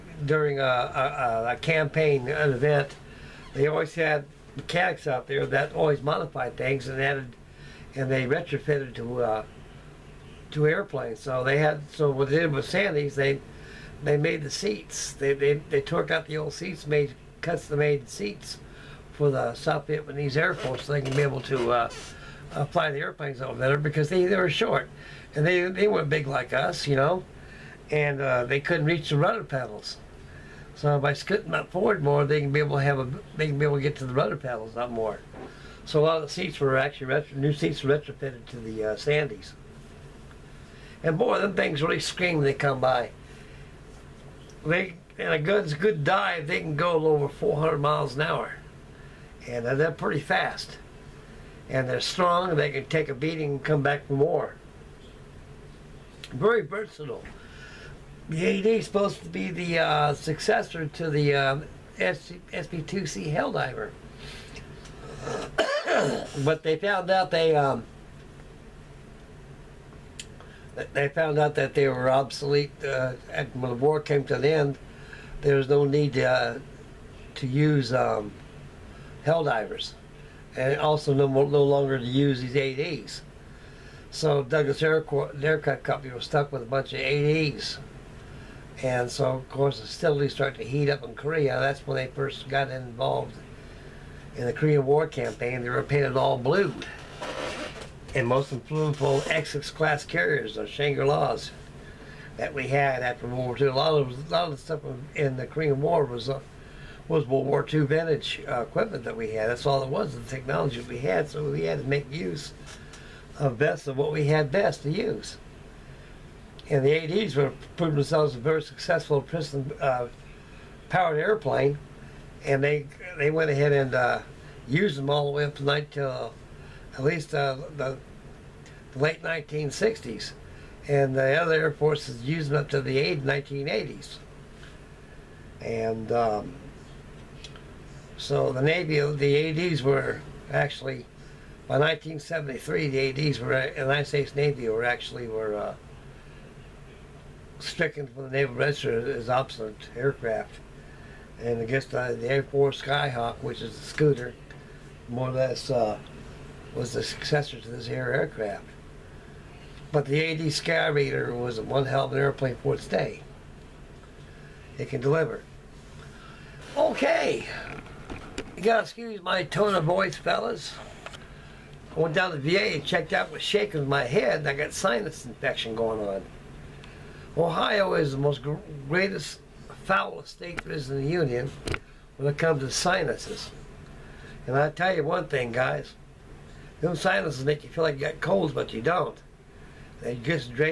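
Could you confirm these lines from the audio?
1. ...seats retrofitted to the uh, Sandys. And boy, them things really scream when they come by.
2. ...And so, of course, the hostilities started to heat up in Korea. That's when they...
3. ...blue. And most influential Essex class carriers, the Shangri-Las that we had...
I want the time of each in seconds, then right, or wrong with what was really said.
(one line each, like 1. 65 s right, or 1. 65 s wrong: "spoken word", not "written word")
1. 37 s right
2. 88 s right
3. 96 s right.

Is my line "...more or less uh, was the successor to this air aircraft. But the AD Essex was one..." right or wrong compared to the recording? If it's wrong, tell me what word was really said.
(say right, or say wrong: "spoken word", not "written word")
wrong: "Skyraider", not "Essex".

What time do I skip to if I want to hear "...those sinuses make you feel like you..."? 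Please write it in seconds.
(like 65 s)
186 s.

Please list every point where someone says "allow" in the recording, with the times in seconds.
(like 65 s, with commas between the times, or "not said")
not said.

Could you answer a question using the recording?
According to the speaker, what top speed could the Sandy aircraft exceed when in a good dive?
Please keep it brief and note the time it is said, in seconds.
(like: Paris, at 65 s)
400 miles an hour, at 47 s.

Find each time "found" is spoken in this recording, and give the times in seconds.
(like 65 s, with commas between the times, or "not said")
66 s, 71 s.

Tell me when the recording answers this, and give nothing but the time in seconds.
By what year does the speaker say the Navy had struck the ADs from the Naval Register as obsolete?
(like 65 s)
141 s.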